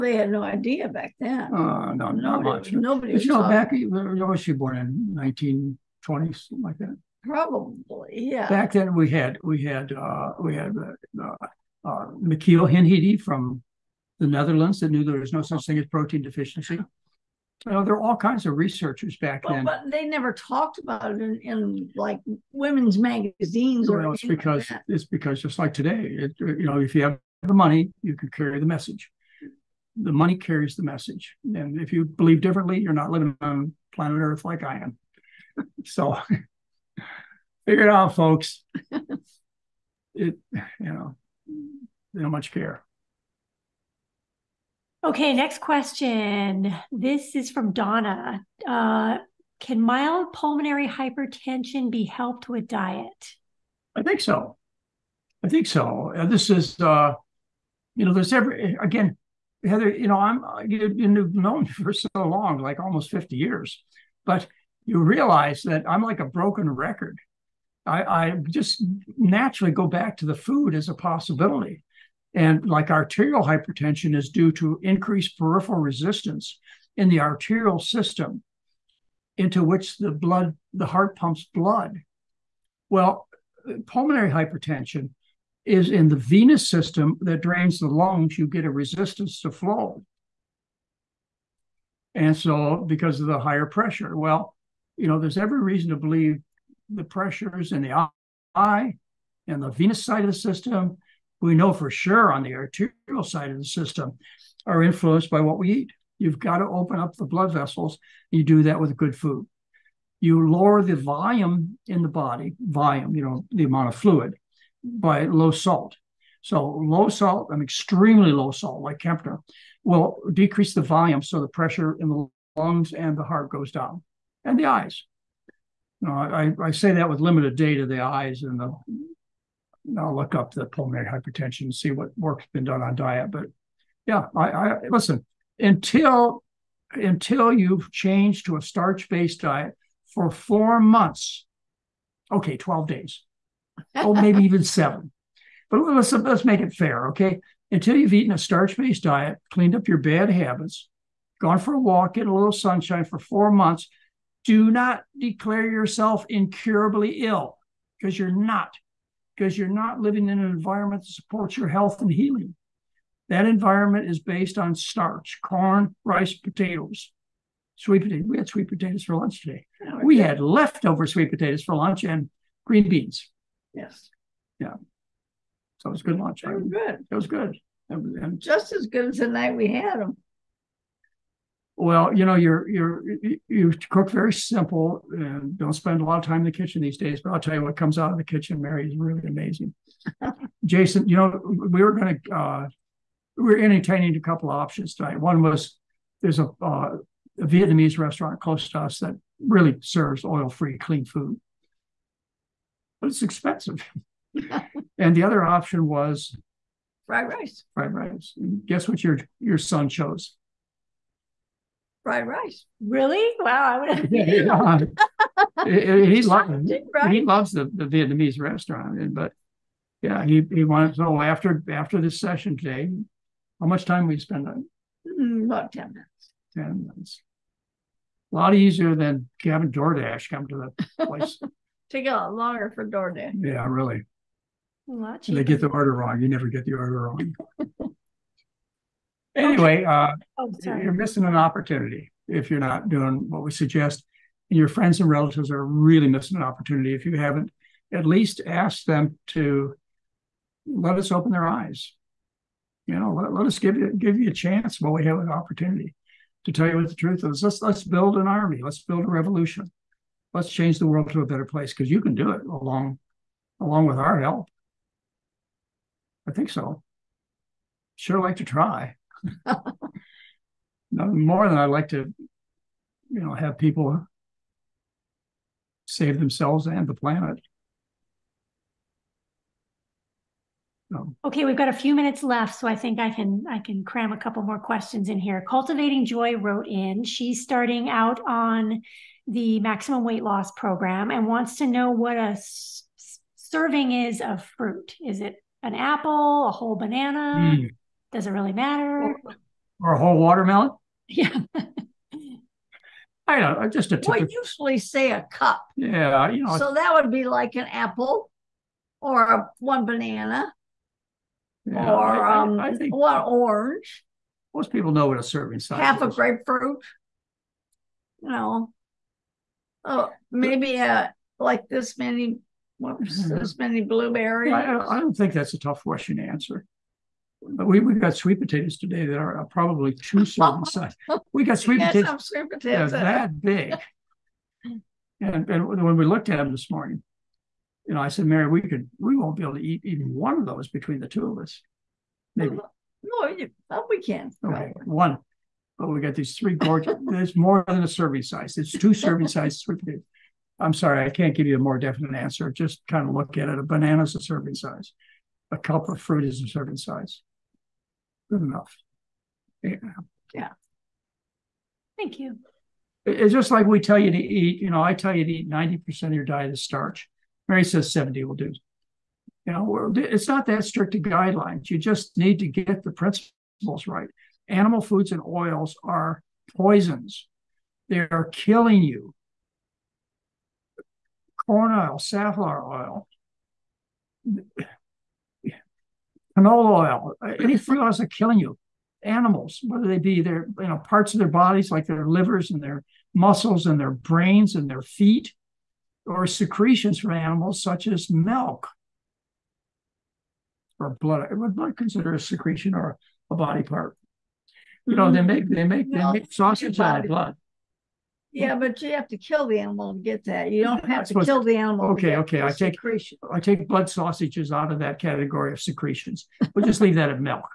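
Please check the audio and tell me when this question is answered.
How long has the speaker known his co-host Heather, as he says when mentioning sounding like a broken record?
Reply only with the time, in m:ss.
1:02.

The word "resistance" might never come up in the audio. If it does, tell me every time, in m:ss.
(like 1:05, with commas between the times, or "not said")
1:15, 1:28.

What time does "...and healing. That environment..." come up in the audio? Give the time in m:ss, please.
2:41.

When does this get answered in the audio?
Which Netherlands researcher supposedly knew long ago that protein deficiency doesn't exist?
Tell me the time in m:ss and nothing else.
0:12.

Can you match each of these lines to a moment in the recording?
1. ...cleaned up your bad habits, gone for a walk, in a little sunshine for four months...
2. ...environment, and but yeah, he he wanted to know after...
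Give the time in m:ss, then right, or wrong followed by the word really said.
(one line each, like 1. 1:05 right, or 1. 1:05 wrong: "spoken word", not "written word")
1. 2:29 right
2. 3:38 wrong: "restaurant", not "environment".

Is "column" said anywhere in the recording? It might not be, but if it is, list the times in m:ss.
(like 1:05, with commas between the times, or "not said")
not said.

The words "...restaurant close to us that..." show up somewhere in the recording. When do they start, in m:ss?
3:17.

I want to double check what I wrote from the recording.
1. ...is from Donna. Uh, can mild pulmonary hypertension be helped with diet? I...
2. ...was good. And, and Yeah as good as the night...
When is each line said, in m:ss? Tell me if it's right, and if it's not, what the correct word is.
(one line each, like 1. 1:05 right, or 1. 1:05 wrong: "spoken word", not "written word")
1. 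0:47 right
2. 2:57 wrong: "Just", not "Yeah".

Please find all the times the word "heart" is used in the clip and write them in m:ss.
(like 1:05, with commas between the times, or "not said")
1:20, 2:03.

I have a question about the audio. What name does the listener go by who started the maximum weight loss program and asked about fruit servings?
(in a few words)
Cultivating Joy.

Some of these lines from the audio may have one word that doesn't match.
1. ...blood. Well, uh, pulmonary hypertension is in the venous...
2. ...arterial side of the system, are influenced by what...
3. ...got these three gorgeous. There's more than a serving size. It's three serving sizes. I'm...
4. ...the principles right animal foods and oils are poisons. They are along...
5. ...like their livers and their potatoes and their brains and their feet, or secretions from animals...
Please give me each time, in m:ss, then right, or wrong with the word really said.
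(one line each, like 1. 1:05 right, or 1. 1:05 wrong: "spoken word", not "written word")
1. 1:21 right
2. 1:42 right
3. 5:45 wrong: "two", not "three"
4. 6:12 wrong: "killing", not "along"
5. 6:31 wrong: "muscles", not "potatoes".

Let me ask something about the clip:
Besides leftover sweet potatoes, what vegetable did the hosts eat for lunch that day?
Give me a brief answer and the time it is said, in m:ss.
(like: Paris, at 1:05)
Green beans, at 2:52.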